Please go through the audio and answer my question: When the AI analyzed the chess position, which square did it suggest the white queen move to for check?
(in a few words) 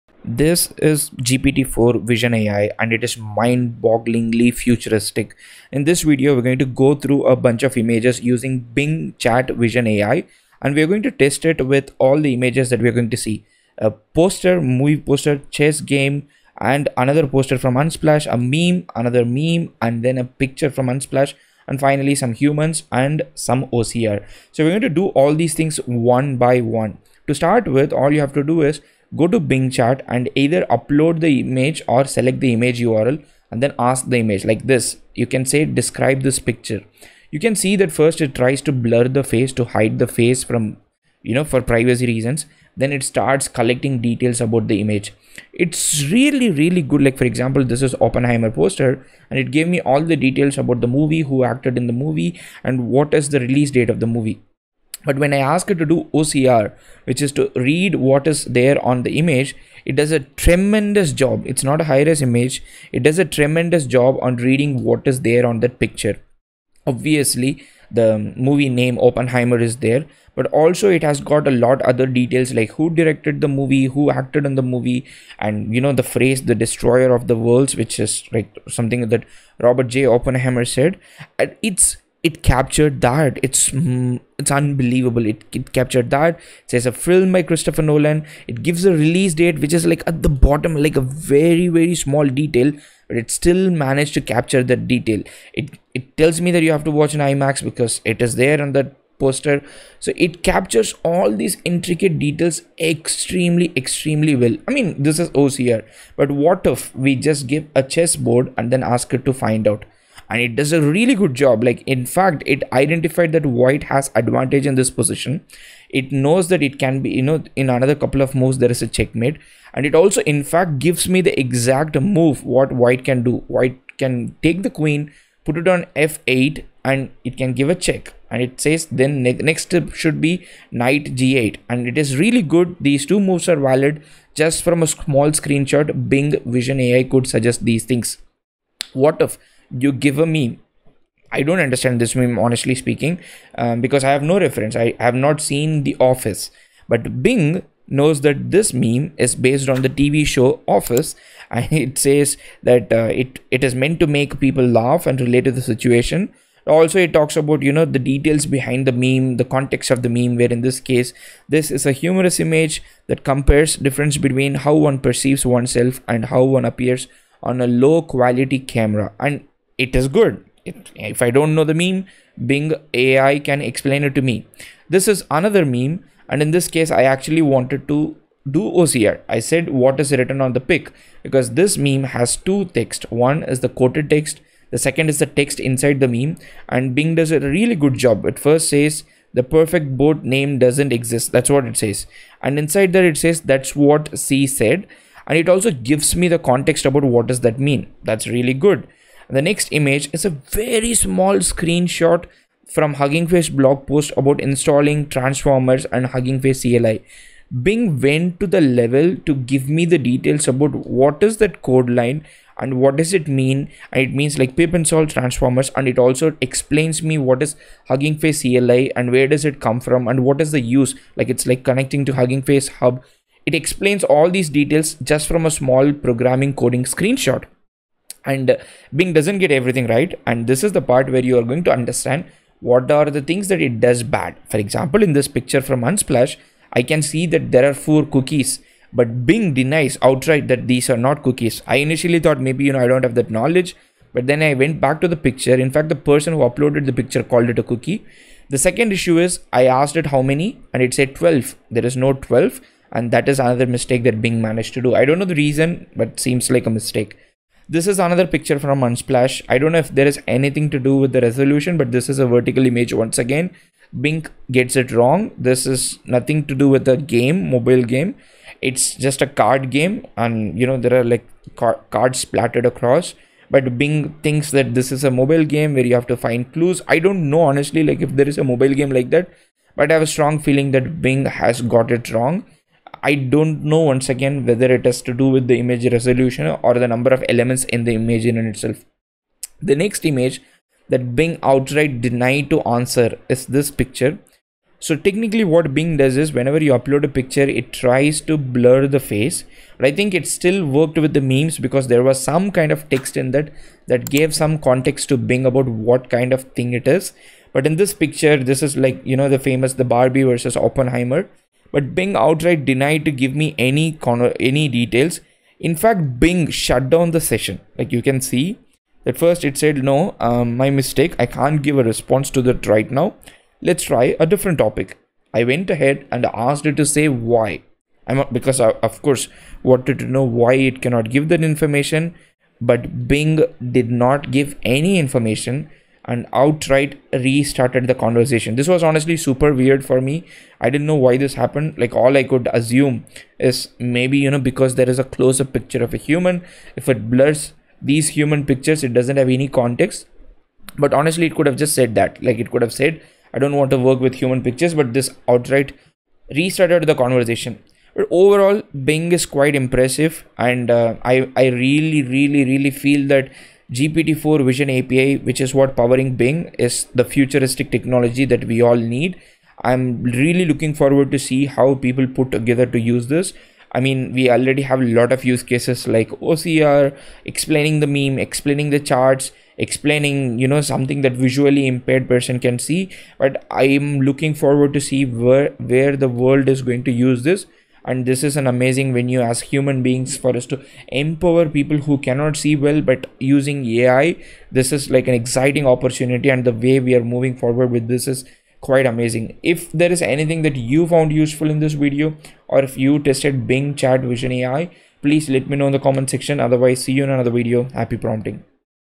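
f8.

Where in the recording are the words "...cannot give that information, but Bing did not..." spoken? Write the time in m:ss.
5:30.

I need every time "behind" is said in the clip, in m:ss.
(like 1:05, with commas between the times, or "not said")
2:38.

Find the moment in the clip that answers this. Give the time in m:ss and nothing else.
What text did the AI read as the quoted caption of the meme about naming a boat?
3:09.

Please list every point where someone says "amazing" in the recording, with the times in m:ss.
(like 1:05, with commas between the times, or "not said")
6:28, 6:38.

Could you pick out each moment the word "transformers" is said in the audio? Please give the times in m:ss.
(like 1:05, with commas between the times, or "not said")
3:25, 3:35.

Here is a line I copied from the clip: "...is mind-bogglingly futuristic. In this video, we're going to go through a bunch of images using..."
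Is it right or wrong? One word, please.
right.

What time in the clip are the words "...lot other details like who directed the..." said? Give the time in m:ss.
1:11.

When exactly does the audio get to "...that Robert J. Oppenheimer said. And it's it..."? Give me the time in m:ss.
1:19.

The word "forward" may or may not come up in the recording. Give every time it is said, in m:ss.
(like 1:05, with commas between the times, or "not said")
6:10, 6:24, 6:37.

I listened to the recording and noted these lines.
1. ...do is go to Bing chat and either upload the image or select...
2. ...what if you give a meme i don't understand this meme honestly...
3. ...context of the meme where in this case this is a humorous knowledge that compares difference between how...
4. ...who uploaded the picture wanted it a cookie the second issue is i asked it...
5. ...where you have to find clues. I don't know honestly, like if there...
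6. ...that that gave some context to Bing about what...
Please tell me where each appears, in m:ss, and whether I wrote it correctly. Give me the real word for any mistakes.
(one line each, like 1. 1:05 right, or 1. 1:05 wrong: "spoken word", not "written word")
1. 0:28 right
2. 2:19 right
3. 2:39 wrong: "image", not "knowledge"
4. 4:06 wrong: "called", not "wanted"
5. 4:35 right
6. 5:03 right.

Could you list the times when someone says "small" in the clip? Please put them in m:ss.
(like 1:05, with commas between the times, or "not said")
1:31, 2:14, 3:20, 3:45.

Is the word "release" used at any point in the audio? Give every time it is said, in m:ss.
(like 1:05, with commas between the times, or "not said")
0:53, 1:28.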